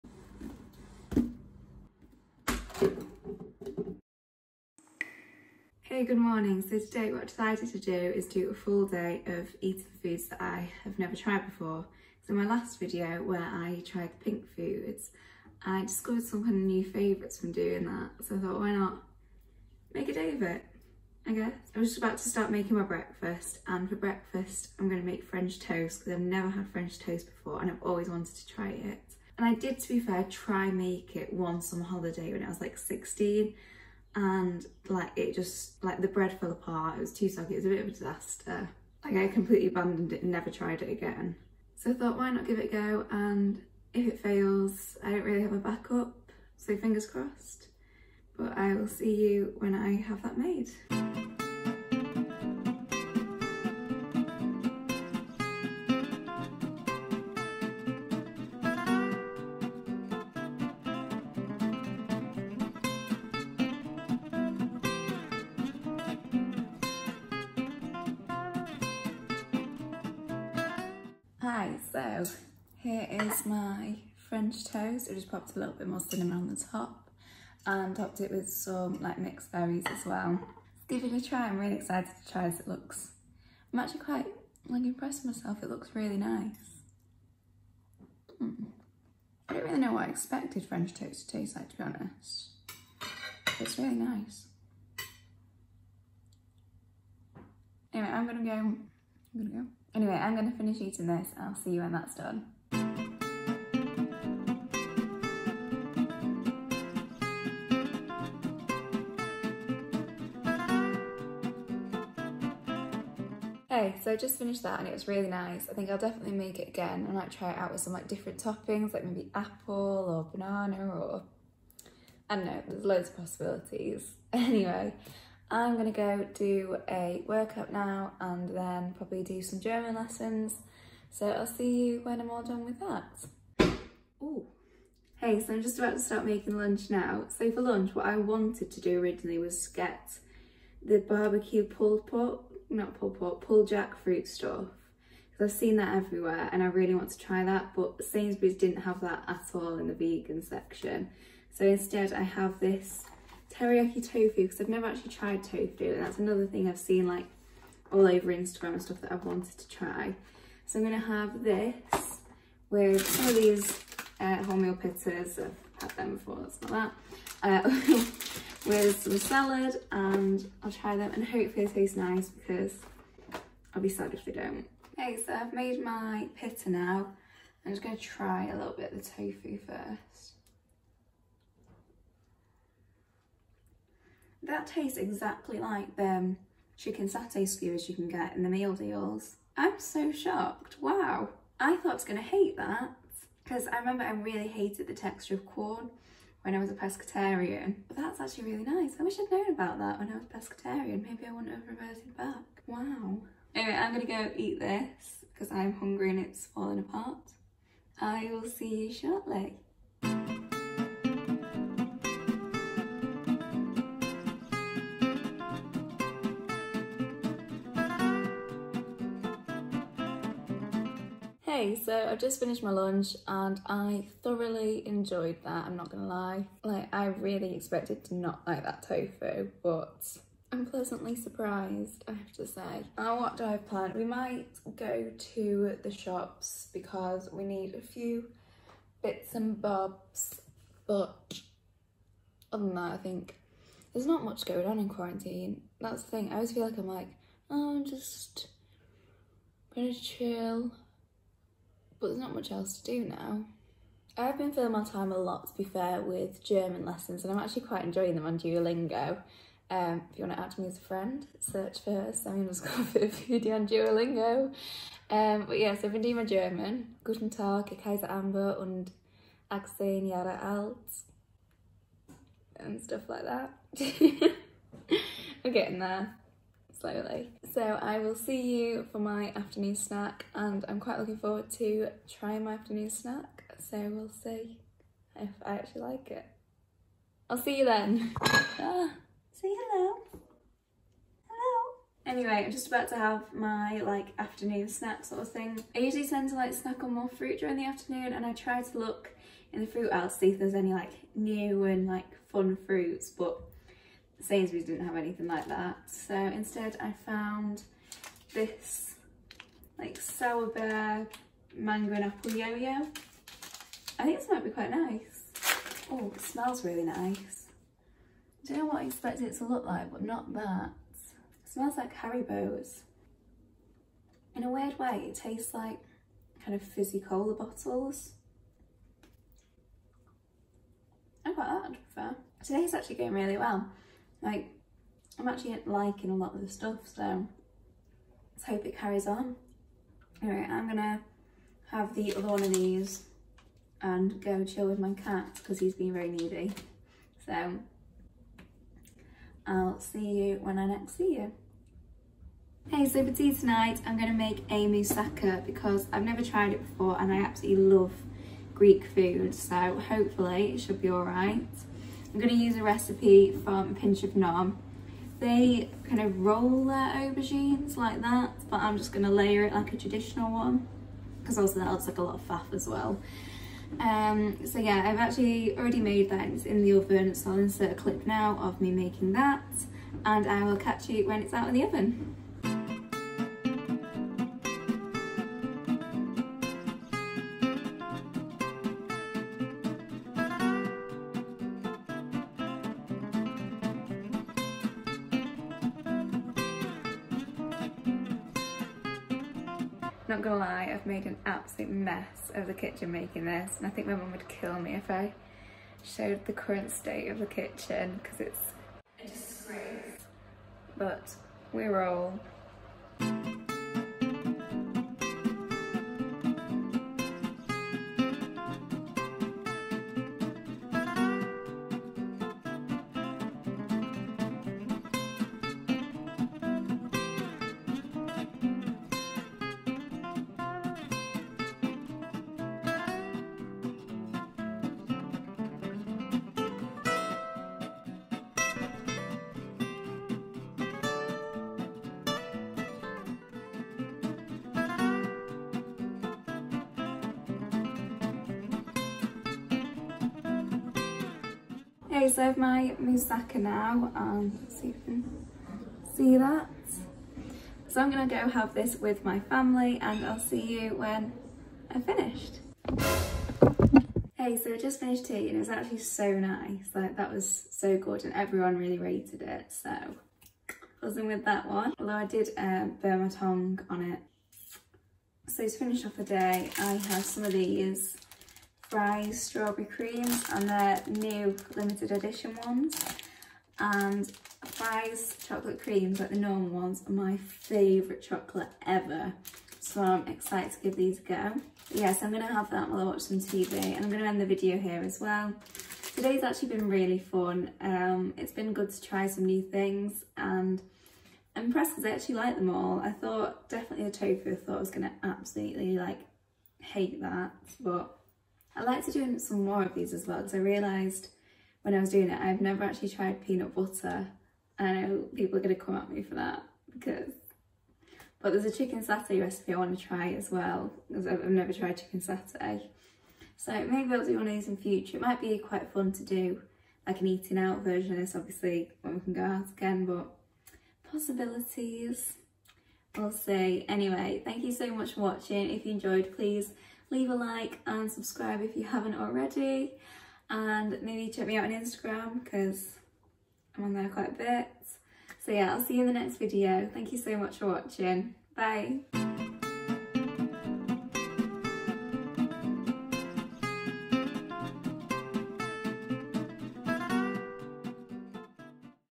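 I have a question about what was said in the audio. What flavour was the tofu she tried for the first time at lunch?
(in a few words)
Teriyaki.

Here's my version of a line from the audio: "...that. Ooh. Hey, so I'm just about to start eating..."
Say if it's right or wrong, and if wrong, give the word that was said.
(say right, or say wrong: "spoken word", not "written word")
wrong: "making", not "eating".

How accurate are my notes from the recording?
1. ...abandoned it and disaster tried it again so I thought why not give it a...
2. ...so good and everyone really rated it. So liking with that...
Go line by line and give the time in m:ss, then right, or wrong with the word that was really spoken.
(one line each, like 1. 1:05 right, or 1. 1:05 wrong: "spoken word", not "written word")
1. 0:39 wrong: "never", not "disaster"
2. 7:47 wrong: "buzzing", not "liking".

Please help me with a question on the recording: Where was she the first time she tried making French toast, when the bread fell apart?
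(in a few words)
On holiday.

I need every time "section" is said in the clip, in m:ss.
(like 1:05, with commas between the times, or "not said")
2:30.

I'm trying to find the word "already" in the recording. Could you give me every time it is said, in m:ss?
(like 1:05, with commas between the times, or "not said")
6:15, 8:58.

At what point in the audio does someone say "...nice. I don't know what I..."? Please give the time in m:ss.
5:16.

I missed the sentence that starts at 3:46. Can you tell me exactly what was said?
Like, I really expected to not like that tofu, but I'm pleasantly surprised, I have to say.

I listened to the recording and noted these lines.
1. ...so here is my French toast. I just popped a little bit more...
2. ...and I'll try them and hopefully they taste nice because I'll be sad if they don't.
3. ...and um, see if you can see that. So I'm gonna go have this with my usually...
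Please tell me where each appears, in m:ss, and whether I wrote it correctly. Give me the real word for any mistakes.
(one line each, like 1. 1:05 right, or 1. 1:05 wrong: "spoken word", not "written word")
1. 1:12 right
2. 2:49 right
3. 7:33 wrong: "family", not "usually".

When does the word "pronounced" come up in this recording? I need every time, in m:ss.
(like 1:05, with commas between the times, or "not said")
not said.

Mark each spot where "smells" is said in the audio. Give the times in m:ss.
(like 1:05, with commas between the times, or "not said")
5:16, 5:21.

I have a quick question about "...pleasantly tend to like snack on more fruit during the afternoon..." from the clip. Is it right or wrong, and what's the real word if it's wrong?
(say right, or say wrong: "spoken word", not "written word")
wrong: "usually", not "pleasantly".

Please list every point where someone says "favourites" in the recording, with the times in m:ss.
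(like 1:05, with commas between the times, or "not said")
0:16, 8:07.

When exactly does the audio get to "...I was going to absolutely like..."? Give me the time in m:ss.
8:24.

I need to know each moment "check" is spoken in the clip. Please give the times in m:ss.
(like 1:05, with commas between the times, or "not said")
9:01.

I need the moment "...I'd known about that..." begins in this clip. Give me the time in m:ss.
3:19.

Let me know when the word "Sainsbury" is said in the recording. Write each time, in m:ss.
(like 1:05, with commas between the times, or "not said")
2:28, 5:04.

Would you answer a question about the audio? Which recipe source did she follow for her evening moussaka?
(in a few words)
Pinch of Nom.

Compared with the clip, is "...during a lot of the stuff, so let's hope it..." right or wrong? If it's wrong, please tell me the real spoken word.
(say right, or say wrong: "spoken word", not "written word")
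wrong: "liking", not "during".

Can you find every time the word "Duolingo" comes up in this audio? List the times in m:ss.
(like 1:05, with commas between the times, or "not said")
4:18, 4:23.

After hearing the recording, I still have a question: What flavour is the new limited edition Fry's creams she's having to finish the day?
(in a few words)
Strawberry.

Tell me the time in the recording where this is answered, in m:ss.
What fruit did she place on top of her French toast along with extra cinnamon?
1:19.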